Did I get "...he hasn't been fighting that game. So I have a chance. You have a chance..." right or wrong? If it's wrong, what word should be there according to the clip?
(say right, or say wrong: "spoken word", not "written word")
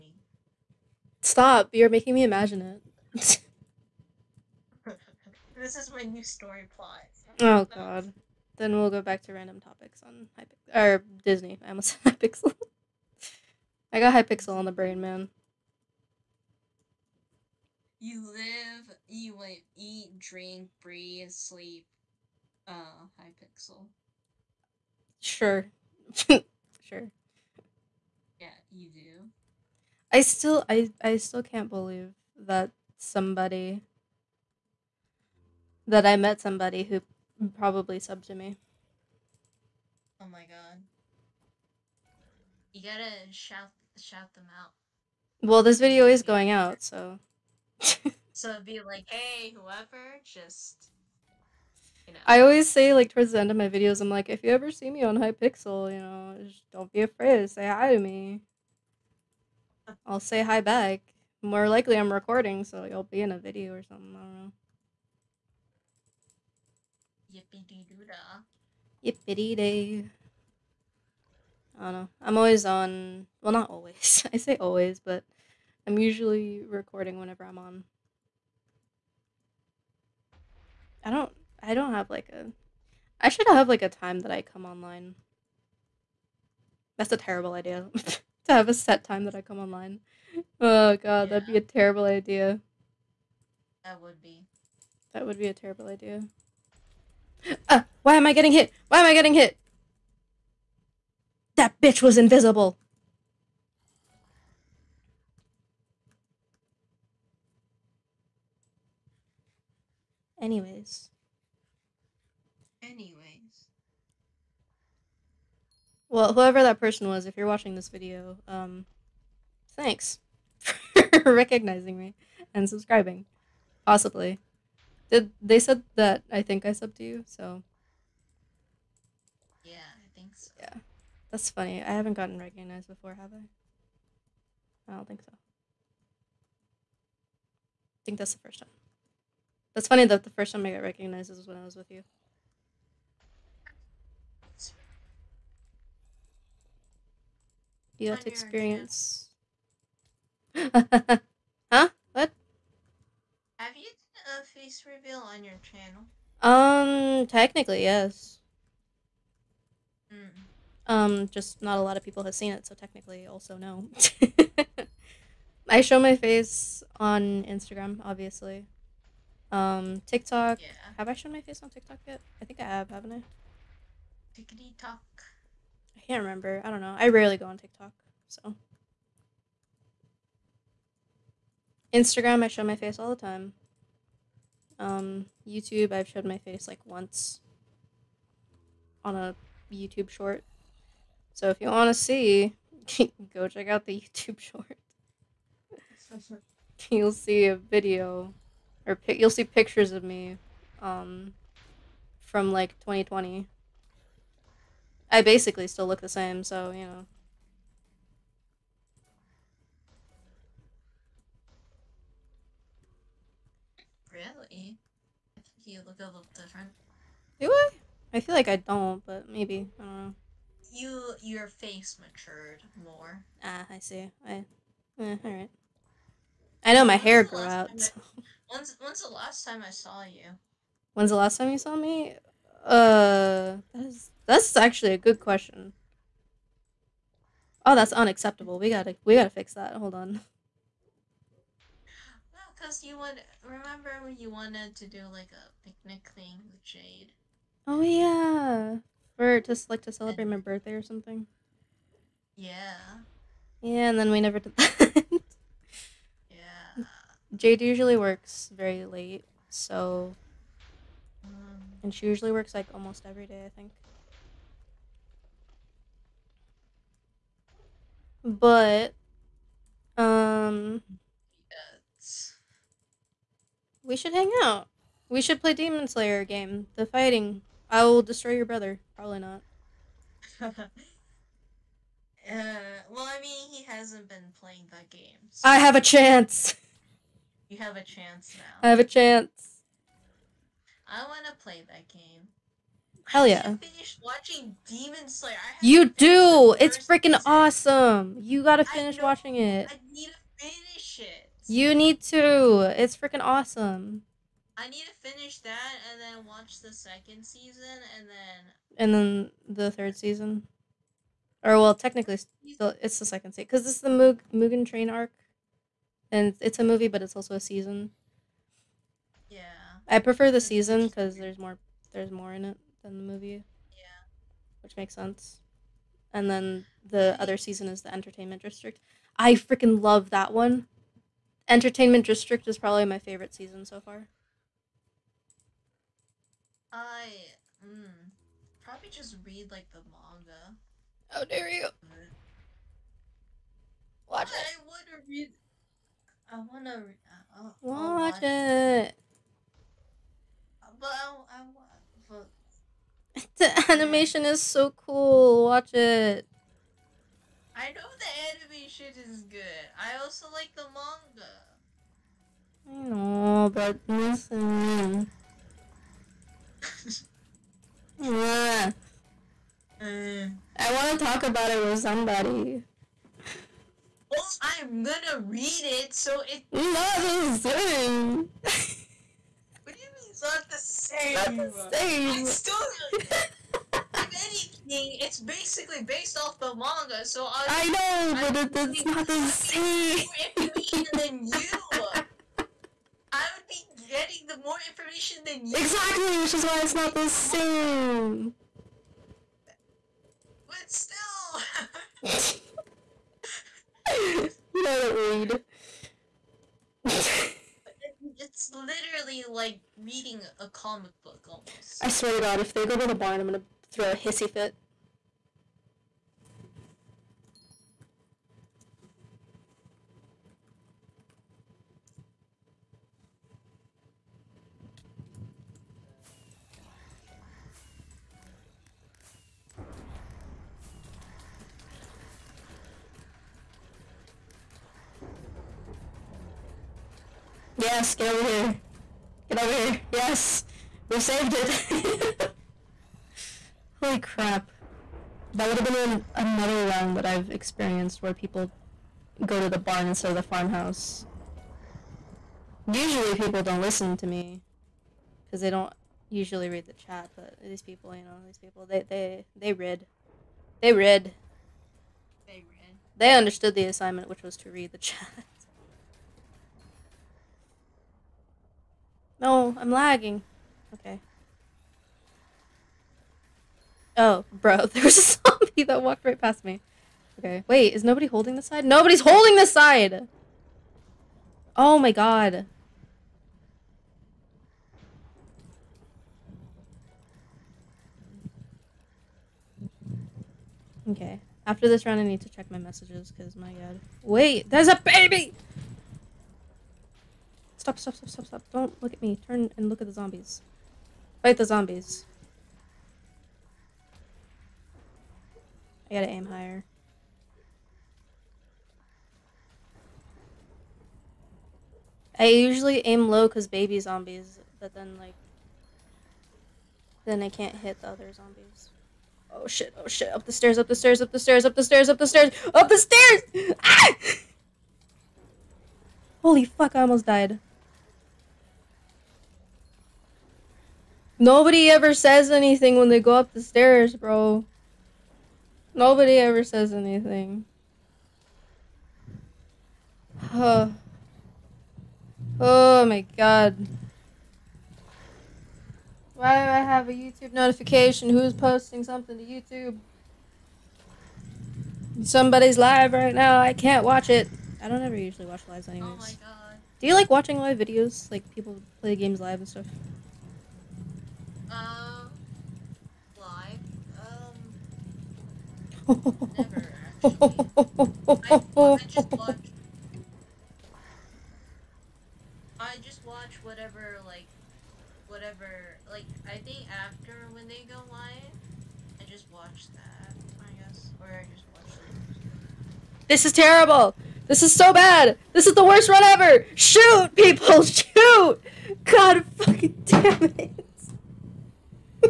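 wrong: "playing", not "fighting".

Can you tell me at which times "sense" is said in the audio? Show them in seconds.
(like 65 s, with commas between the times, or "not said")
324 s.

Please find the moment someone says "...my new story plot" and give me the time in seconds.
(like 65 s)
5 s.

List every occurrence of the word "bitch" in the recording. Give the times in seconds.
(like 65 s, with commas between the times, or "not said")
101 s.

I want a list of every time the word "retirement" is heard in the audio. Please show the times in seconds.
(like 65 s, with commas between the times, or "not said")
not said.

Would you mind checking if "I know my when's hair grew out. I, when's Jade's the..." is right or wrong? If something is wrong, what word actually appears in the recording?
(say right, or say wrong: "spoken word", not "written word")
wrong: "When", not "Jade".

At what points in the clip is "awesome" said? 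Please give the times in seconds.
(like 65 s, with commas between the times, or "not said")
297 s, 303 s.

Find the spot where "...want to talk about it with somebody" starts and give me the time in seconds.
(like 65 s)
370 s.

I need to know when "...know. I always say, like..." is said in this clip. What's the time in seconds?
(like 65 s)
52 s.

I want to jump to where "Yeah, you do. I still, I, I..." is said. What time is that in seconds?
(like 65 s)
28 s.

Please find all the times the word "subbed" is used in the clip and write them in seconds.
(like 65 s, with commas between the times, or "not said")
37 s, 126 s.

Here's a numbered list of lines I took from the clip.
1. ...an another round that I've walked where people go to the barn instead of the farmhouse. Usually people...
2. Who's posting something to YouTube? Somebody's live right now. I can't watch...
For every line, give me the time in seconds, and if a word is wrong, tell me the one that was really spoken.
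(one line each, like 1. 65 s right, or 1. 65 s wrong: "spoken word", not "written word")
1. 445 s wrong: "experienced", not "walked"
2. 548 s right.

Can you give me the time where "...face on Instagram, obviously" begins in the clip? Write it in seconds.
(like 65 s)
166 s.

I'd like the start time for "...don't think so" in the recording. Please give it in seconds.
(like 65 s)
134 s.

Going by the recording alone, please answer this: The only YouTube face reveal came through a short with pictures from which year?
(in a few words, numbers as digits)
2020.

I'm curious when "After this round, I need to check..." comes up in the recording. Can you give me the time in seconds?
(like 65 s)
491 s.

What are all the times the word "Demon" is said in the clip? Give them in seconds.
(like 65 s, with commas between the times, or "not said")
275 s, 294 s.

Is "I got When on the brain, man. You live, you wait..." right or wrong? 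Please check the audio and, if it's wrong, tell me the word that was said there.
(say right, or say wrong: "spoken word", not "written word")
wrong: "Hypixel", not "When".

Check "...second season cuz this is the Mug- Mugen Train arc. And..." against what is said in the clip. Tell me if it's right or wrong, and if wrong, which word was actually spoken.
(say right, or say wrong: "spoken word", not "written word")
right.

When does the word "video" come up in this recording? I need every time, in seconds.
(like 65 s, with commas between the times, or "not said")
45 s, 53 s, 63 s, 117 s, 197 s, 557 s.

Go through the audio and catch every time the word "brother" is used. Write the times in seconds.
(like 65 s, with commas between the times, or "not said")
278 s.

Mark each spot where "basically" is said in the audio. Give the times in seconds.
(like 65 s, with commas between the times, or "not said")
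205 s, 385 s.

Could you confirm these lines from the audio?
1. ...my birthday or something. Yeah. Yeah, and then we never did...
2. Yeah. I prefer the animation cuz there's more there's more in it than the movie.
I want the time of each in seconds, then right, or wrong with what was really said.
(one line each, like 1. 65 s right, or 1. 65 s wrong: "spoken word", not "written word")
1. 250 s right
2. 319 s wrong: "season", not "animation".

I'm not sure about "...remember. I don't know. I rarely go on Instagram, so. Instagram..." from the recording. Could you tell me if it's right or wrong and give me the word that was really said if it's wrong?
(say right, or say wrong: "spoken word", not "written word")
wrong: "TikTok", not "Instagram".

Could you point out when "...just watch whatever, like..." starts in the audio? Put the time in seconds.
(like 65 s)
572 s.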